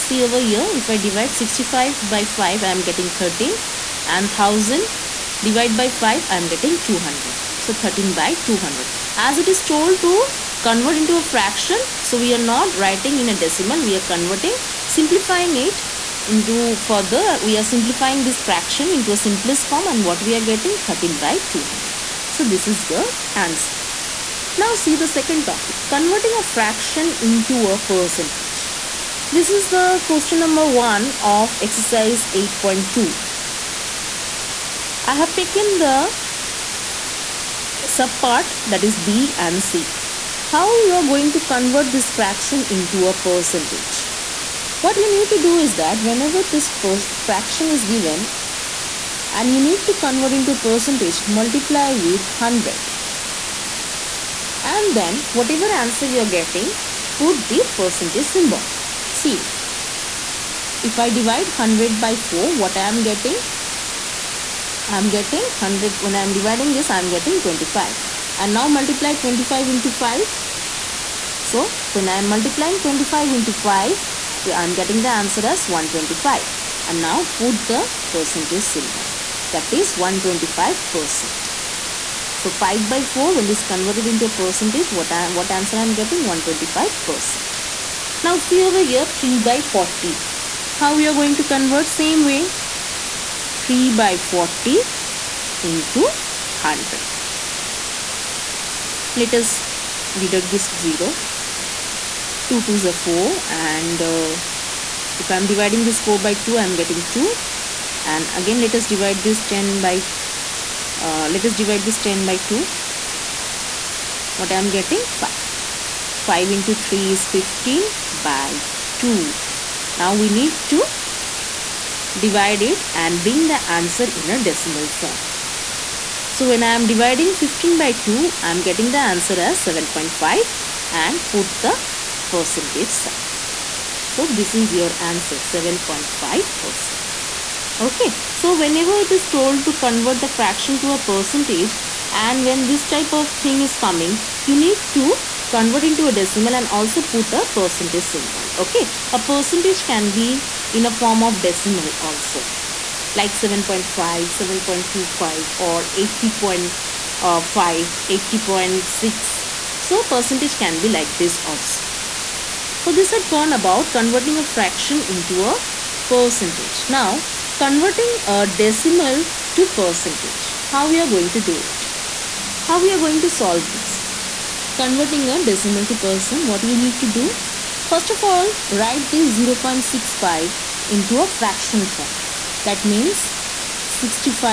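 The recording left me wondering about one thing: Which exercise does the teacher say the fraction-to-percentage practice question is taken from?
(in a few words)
Exercise 8.2.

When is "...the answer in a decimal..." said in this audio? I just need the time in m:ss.
2:03.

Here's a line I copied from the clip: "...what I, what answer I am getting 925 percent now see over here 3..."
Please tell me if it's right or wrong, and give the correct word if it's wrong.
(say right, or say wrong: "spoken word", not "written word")
wrong: "125", not "925".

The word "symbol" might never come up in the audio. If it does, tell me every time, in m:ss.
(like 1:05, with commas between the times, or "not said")
0:58, 1:18, 2:28.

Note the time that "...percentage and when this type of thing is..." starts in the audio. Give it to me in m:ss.
2:20.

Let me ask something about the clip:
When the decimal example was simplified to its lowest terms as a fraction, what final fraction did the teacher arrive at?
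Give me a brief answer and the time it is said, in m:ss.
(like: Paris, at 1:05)
13/200, at 0:20.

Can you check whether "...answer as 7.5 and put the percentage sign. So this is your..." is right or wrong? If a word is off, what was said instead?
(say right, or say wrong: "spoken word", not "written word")
right.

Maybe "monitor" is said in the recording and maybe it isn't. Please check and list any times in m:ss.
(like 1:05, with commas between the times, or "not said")
not said.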